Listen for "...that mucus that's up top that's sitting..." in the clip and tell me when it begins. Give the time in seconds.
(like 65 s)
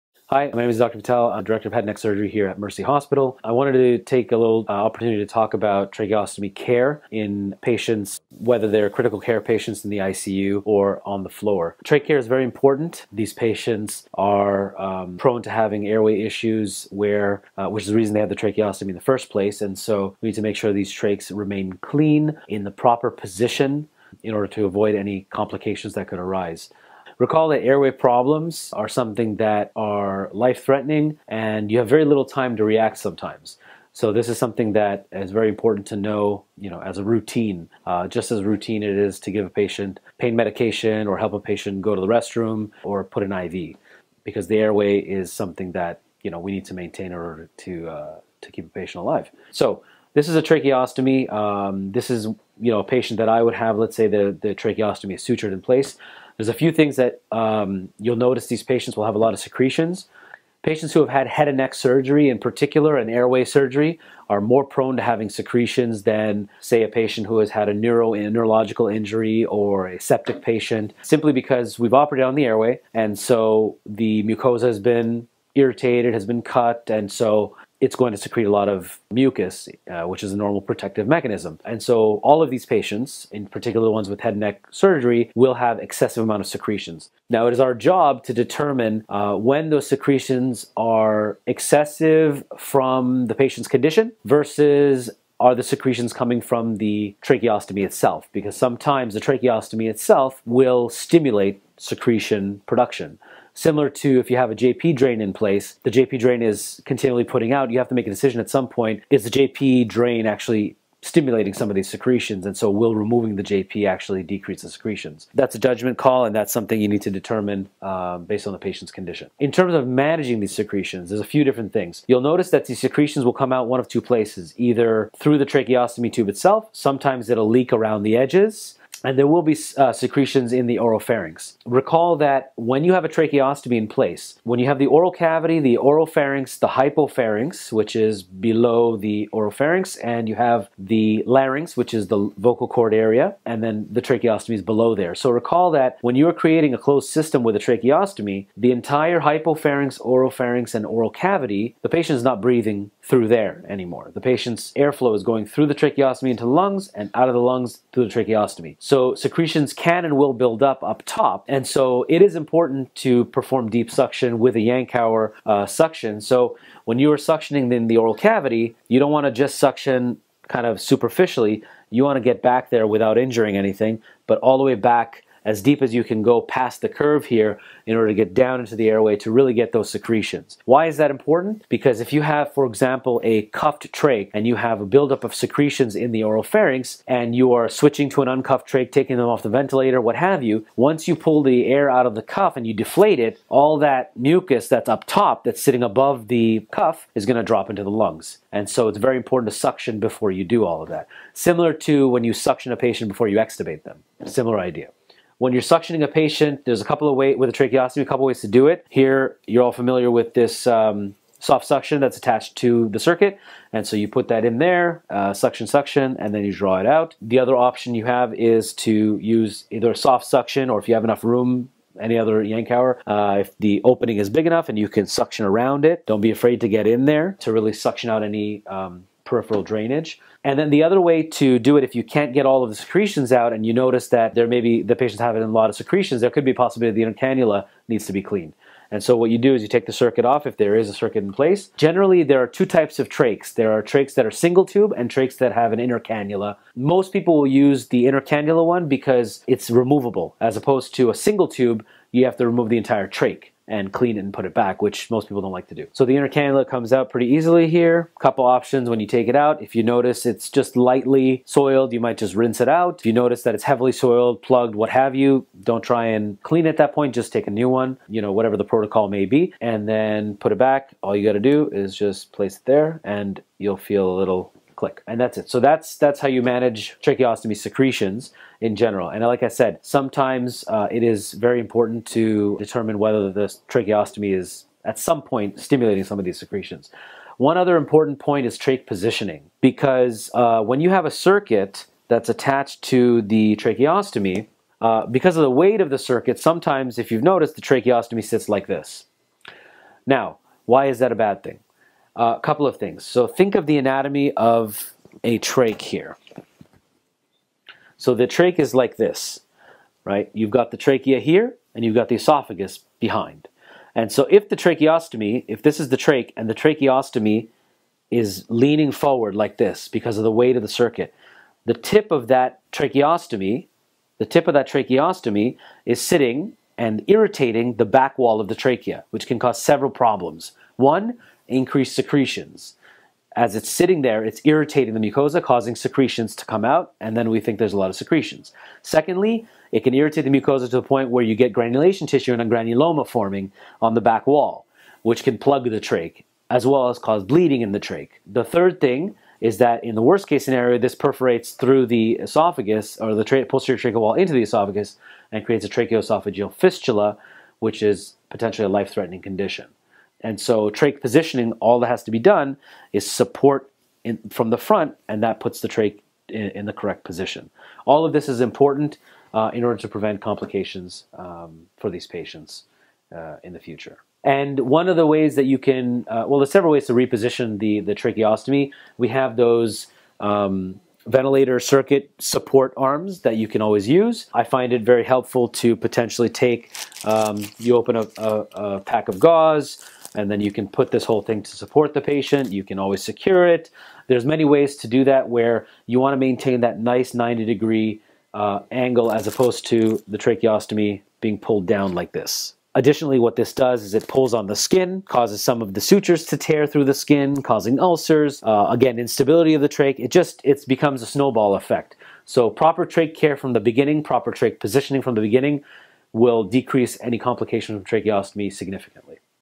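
193 s.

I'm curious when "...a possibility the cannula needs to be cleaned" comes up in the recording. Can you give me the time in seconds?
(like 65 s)
236 s.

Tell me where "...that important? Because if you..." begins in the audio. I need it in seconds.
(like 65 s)
180 s.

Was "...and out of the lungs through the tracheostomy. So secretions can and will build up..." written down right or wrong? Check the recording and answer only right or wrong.
right.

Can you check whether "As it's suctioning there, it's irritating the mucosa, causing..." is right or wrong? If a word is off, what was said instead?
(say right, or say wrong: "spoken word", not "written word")
wrong: "sitting", not "suctioning".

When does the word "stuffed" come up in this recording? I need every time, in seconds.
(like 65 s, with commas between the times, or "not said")
not said.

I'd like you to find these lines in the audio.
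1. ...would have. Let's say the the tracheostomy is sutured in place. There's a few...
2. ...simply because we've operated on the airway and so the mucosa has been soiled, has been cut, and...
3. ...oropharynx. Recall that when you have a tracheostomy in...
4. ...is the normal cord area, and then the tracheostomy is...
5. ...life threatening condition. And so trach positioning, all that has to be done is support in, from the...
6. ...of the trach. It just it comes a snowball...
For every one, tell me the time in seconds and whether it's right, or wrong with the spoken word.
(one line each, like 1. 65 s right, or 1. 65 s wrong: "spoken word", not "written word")
1. 53 s right
2. 71 s wrong: "irritated", not "soiled"
3. 130 s right
4. 141 s wrong: "vocal", not "normal"
5. 358 s right
6. 409 s wrong: "becomes", not "comes".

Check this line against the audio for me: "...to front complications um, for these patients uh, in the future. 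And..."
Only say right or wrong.
wrong.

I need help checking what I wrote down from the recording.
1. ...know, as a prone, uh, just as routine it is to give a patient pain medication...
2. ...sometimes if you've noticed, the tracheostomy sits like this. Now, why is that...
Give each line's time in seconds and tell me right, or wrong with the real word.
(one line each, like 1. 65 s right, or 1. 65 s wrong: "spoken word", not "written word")
1. 36 s wrong: "routine", not "prone"
2. 296 s right.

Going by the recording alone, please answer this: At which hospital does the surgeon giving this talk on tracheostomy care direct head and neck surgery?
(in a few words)
Mercy Hospital.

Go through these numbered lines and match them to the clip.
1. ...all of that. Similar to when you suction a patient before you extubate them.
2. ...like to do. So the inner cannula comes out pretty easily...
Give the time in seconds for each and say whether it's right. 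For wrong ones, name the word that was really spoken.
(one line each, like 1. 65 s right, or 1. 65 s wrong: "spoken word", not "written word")
1. 200 s right
2. 255 s right.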